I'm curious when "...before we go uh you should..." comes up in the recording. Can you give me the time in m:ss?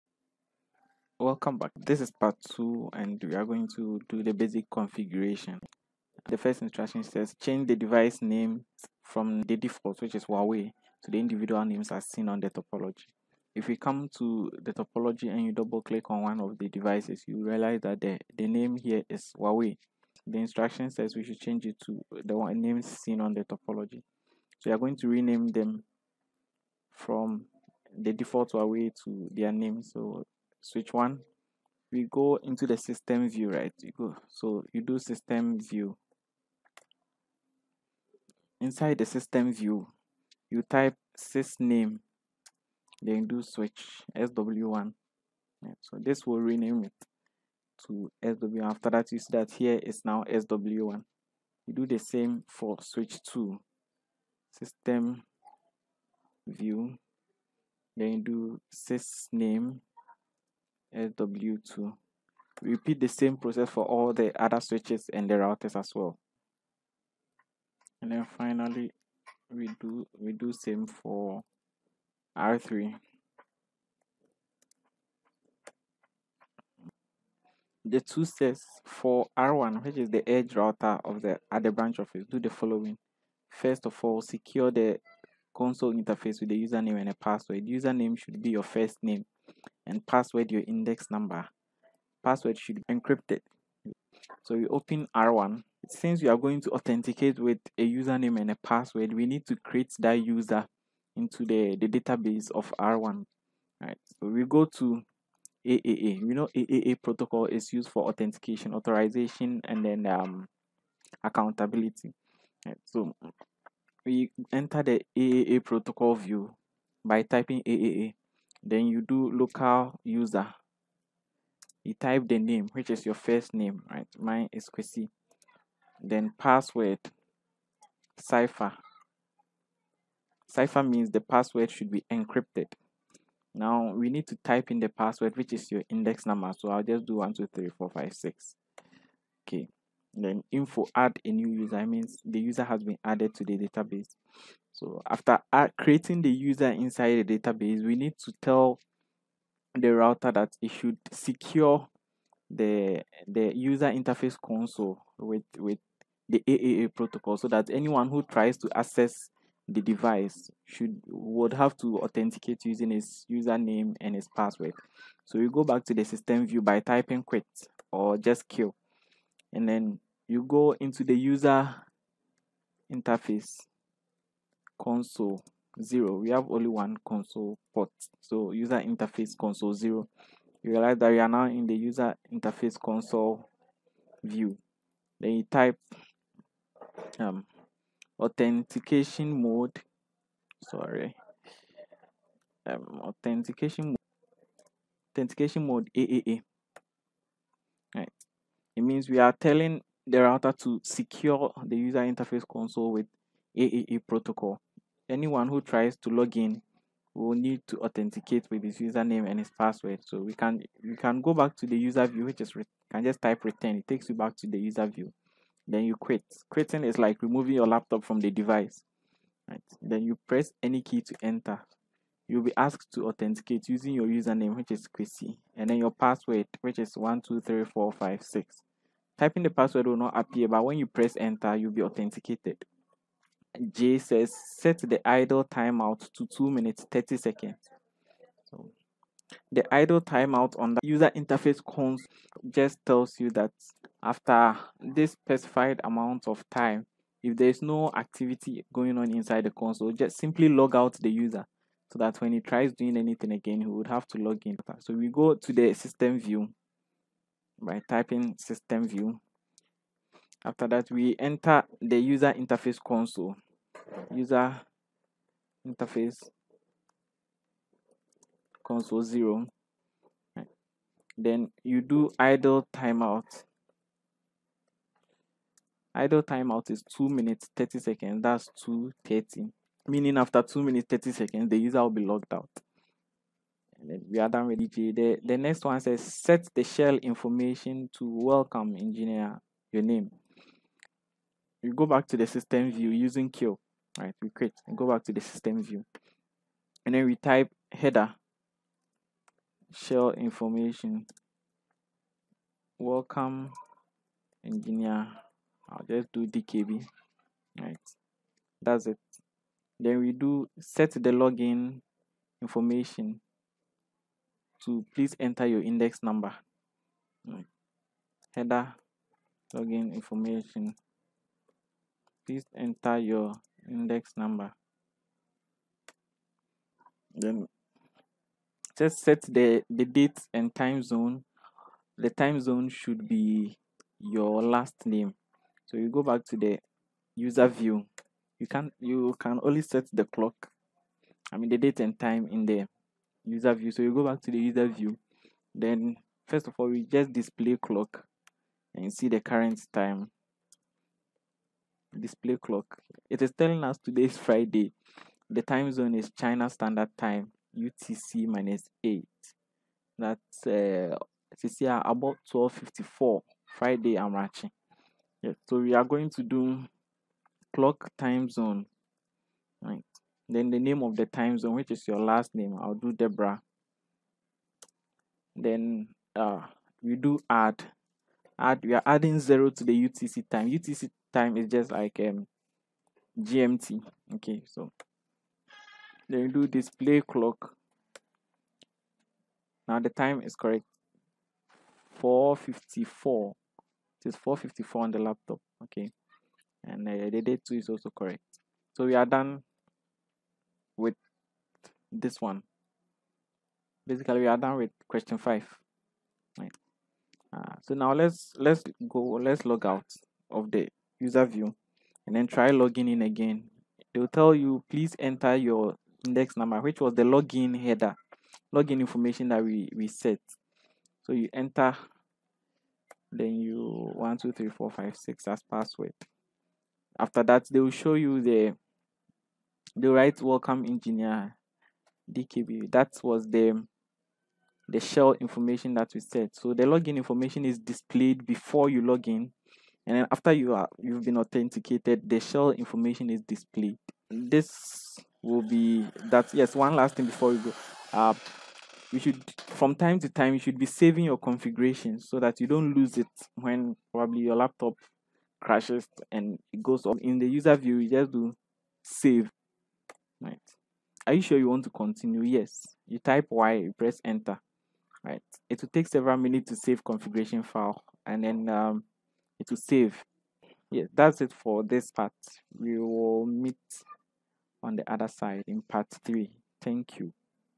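7:27.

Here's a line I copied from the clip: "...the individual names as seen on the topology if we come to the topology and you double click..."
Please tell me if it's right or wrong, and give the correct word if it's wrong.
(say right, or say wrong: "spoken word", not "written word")
right.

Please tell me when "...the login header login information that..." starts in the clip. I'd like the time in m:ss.
6:56.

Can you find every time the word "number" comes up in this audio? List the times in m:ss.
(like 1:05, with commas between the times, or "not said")
1:31, 2:16, 5:16, 5:24, 6:56.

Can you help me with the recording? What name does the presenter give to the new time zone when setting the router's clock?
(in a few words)
Deborah.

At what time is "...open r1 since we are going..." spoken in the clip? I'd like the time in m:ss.
1:34.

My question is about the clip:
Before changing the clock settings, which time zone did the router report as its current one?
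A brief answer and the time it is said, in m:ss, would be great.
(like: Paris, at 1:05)
China Standard Time, at 5:56.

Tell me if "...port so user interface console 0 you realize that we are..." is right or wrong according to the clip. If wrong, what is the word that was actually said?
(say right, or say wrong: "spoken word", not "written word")
right.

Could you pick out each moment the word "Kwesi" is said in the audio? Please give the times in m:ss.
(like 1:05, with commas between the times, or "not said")
2:04, 3:44.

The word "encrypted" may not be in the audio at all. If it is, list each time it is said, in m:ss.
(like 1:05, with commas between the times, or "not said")
1:32, 2:12.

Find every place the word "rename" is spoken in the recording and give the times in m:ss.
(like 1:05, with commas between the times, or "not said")
0:25, 0:46.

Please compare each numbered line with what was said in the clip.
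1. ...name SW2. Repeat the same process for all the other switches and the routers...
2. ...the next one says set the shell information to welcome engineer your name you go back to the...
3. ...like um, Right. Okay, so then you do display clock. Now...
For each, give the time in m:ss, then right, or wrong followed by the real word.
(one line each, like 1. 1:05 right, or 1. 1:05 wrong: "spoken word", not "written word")
1. 0:59 right
2. 4:45 right
3. 6:21 wrong: "GMT", not "Right".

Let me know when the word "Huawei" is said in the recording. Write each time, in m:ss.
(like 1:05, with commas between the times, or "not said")
0:10, 0:19, 0:28.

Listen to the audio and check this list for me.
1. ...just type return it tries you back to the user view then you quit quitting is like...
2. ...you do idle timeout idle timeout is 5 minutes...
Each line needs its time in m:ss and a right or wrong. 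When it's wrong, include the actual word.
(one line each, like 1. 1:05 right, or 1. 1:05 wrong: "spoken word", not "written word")
1. 3:33 wrong: "takes", not "tries"
2. 4:31 wrong: "2", not "5".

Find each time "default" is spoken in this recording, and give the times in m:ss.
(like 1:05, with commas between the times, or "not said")
0:09, 0:28.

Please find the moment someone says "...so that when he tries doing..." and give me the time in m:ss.
4:11.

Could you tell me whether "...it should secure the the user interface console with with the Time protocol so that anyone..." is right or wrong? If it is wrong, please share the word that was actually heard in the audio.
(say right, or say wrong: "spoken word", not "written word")
wrong: "AAA", not "Time".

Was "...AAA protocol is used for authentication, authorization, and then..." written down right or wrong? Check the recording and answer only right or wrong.
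right.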